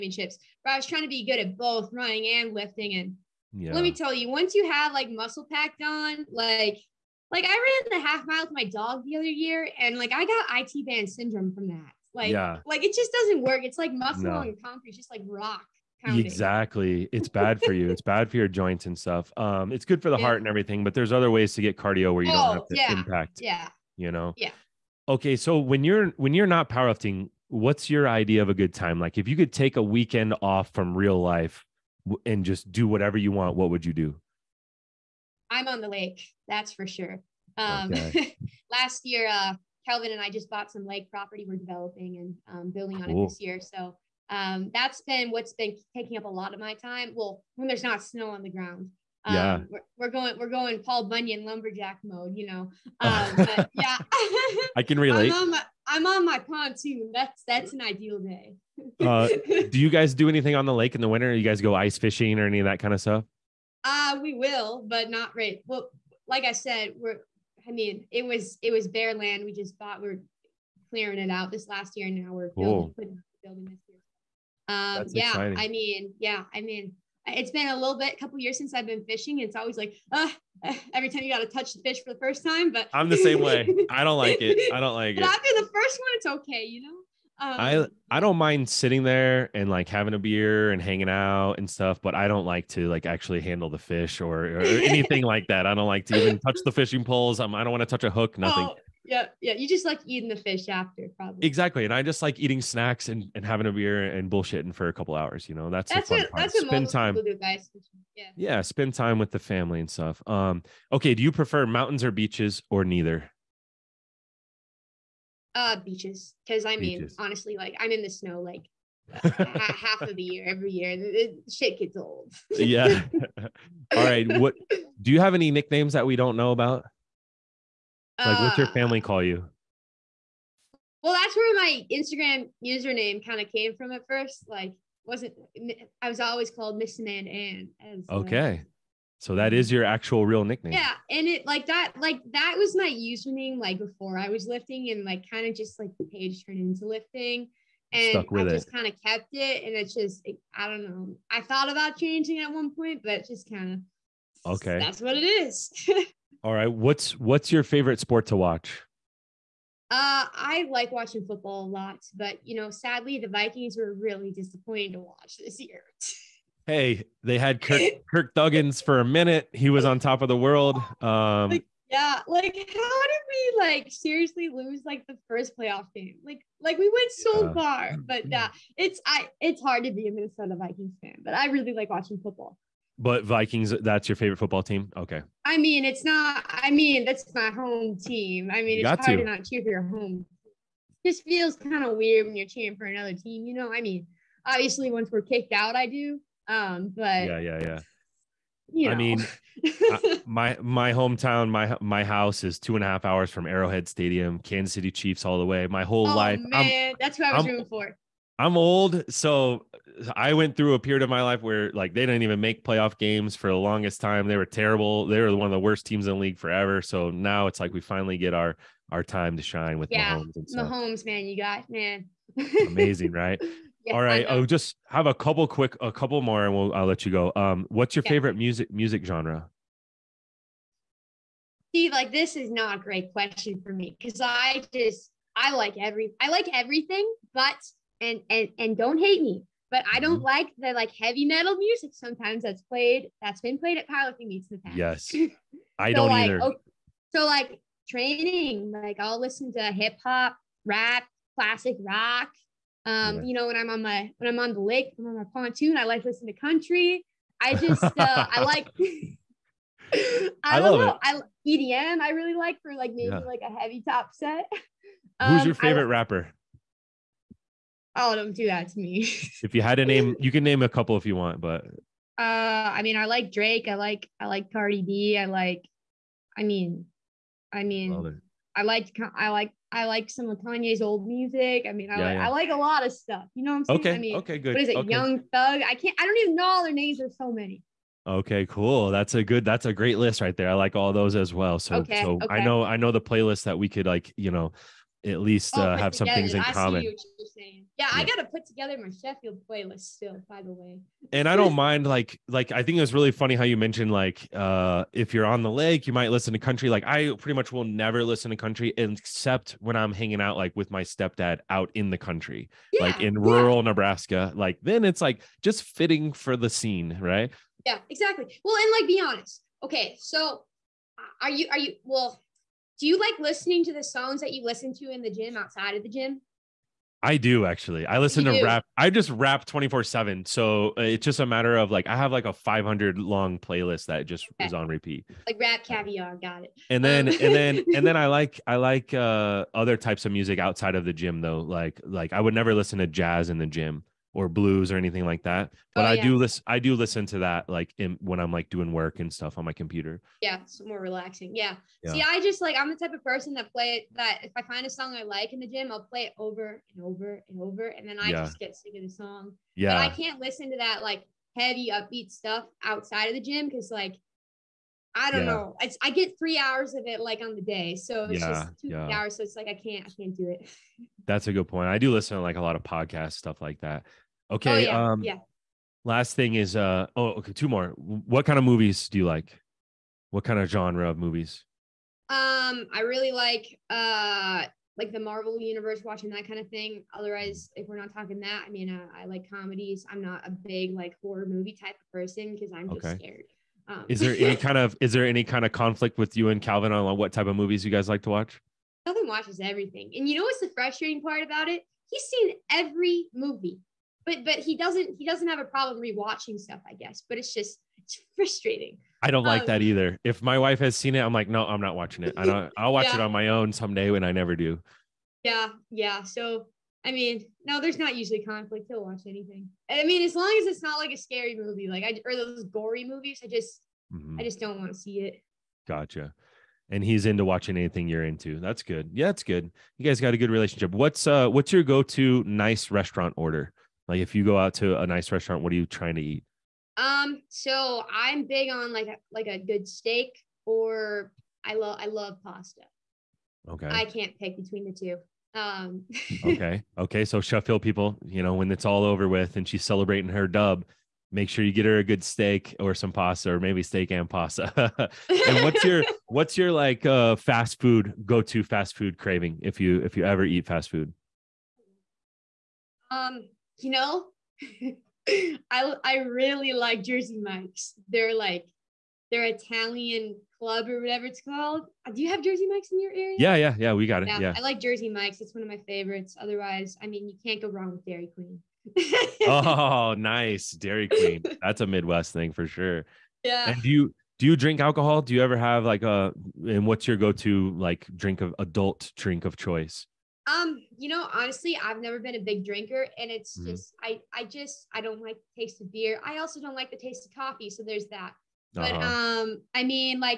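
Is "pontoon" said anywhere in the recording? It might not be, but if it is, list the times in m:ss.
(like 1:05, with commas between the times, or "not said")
0:56, 4:15.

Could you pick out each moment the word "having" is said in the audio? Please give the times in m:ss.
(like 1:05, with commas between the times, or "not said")
1:29, 1:43.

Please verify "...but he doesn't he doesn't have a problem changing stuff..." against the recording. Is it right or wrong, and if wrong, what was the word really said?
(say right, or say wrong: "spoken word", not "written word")
wrong: "rewatching", not "changing".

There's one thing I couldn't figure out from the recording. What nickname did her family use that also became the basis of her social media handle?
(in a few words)
Miss Man Ann.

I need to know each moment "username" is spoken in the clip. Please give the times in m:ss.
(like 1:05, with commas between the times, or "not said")
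2:12, 2:22.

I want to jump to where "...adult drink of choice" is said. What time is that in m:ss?
8:08.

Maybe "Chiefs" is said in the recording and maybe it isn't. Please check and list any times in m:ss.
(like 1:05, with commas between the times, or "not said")
3:24.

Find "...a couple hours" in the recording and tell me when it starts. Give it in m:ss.
1:44.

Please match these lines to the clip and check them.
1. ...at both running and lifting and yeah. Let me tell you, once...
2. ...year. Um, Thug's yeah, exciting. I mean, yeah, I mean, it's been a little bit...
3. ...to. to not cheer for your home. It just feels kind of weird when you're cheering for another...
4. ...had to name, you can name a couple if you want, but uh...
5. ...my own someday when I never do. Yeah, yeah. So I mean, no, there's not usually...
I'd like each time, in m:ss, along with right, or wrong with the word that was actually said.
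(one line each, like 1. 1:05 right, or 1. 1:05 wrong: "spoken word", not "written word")
1. 0:01 right
2. 1:13 wrong: "That", not "Thug"
3. 3:09 right
4. 4:29 right
5. 6:53 right.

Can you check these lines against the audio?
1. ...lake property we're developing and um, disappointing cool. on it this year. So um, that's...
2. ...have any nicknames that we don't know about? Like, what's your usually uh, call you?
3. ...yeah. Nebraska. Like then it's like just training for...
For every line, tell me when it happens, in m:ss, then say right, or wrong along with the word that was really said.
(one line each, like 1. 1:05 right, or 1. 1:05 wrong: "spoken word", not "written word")
1. 0:40 wrong: "building", not "disappointing"
2. 2:05 wrong: "family", not "usually"
3. 5:13 wrong: "fitting", not "training".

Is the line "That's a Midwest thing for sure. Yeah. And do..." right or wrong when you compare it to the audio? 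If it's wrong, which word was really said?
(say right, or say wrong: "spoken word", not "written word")
right.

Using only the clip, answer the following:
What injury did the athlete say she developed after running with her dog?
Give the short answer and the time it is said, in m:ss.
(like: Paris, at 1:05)
IT band syndrome, at 0:10.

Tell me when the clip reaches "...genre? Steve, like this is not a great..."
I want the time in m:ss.
3:49.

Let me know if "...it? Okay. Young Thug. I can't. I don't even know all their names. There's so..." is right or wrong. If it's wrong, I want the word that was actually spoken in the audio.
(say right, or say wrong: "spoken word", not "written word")
right.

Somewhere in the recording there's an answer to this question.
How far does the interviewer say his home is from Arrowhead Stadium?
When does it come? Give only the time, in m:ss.
3:22.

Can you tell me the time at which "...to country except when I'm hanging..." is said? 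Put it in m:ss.
5:08.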